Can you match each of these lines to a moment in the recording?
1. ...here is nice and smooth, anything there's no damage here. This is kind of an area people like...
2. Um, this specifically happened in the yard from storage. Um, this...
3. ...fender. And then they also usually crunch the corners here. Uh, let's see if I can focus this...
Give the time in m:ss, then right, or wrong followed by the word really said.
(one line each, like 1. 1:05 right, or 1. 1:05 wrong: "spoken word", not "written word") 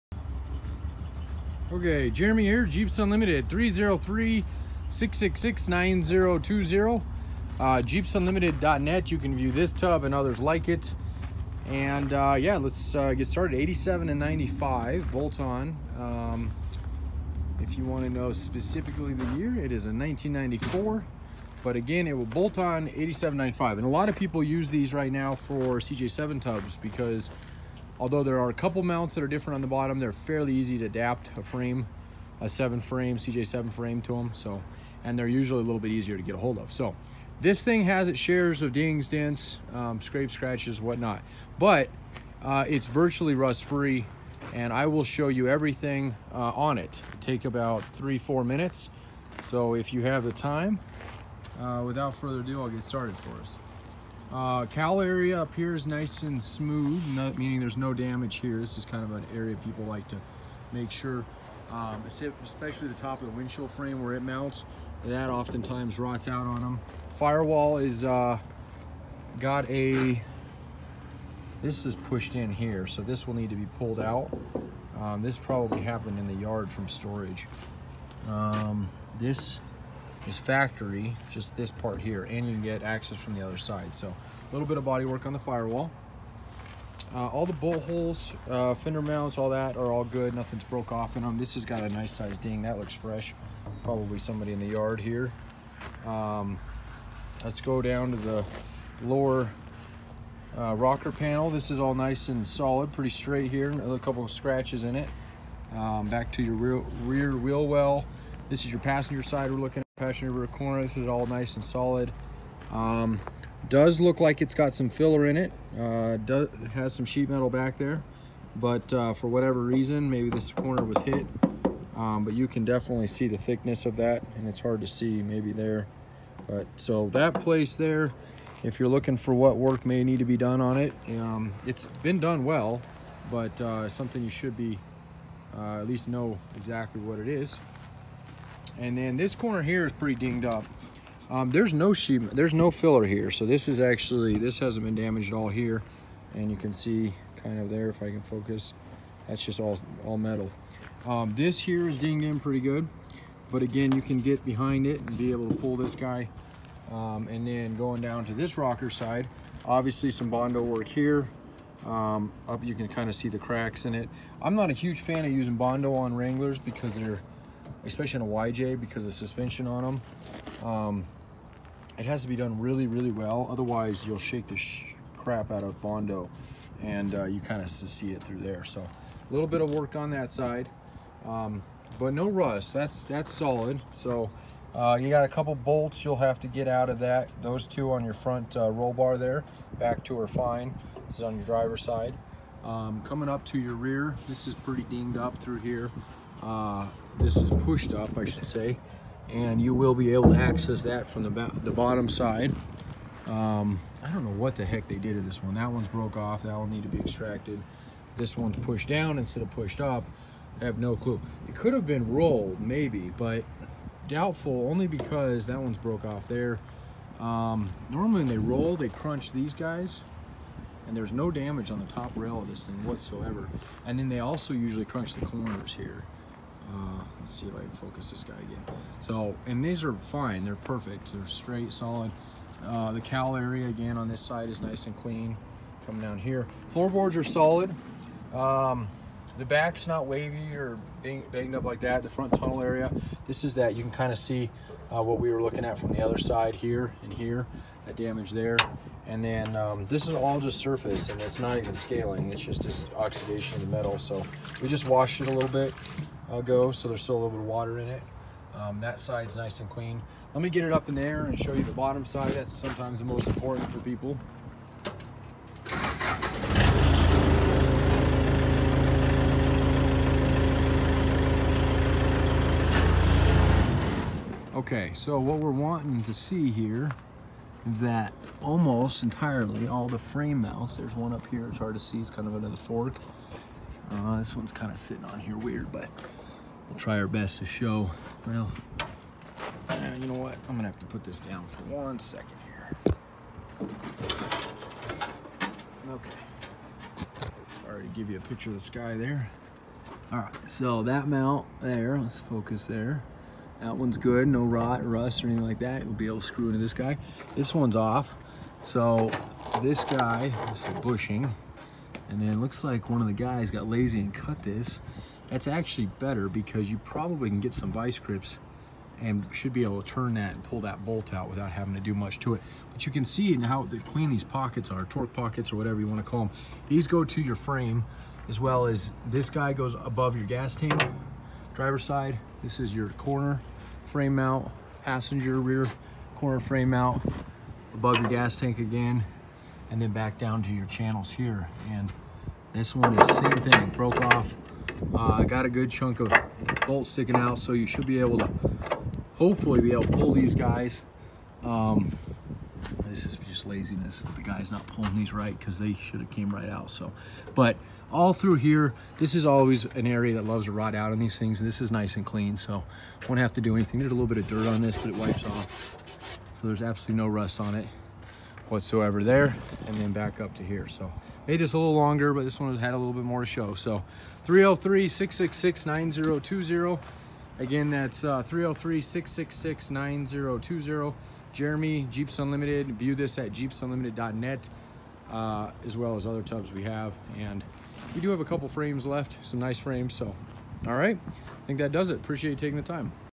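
1. 0:55 wrong: "meaning", not "anything"
2. 1:14 wrong: "probably", not "specifically"
3. 3:42 wrong: "whatsoever", not "fender".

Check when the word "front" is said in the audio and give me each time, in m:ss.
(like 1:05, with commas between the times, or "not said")
3:08, 4:02.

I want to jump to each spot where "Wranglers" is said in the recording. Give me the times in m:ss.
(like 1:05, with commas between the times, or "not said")
2:46.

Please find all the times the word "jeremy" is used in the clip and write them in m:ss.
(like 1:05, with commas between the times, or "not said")
0:02, 6:21.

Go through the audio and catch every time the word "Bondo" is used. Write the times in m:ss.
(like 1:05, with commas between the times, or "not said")
2:40, 2:45, 2:55.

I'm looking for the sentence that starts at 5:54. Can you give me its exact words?
The guy's not pulling these right because they should have came right out.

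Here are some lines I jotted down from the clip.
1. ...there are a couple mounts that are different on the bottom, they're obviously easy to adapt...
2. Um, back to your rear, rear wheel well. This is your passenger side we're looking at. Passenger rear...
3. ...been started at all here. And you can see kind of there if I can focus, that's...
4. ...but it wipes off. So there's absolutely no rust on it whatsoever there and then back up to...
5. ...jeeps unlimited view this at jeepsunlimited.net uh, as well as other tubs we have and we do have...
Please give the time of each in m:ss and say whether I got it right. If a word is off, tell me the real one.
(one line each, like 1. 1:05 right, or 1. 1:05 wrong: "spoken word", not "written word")
1. 0:28 wrong: "fairly", not "obviously"
2. 1:45 right
3. 2:24 wrong: "damaged", not "started"
4. 6:04 right
5. 6:21 right.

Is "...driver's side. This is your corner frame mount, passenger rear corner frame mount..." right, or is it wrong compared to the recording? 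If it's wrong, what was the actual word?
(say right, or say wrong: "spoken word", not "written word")
right.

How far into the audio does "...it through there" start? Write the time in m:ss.
2:58.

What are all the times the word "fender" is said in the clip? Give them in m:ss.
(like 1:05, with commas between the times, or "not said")
1:28.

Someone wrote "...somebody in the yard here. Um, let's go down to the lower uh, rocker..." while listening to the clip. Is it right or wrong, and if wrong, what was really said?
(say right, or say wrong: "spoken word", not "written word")
right.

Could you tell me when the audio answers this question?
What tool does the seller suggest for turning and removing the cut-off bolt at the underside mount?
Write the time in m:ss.
5:17.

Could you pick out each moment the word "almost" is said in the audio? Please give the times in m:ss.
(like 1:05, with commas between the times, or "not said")
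4:38.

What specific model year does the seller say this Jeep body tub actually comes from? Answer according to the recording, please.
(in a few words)
1994.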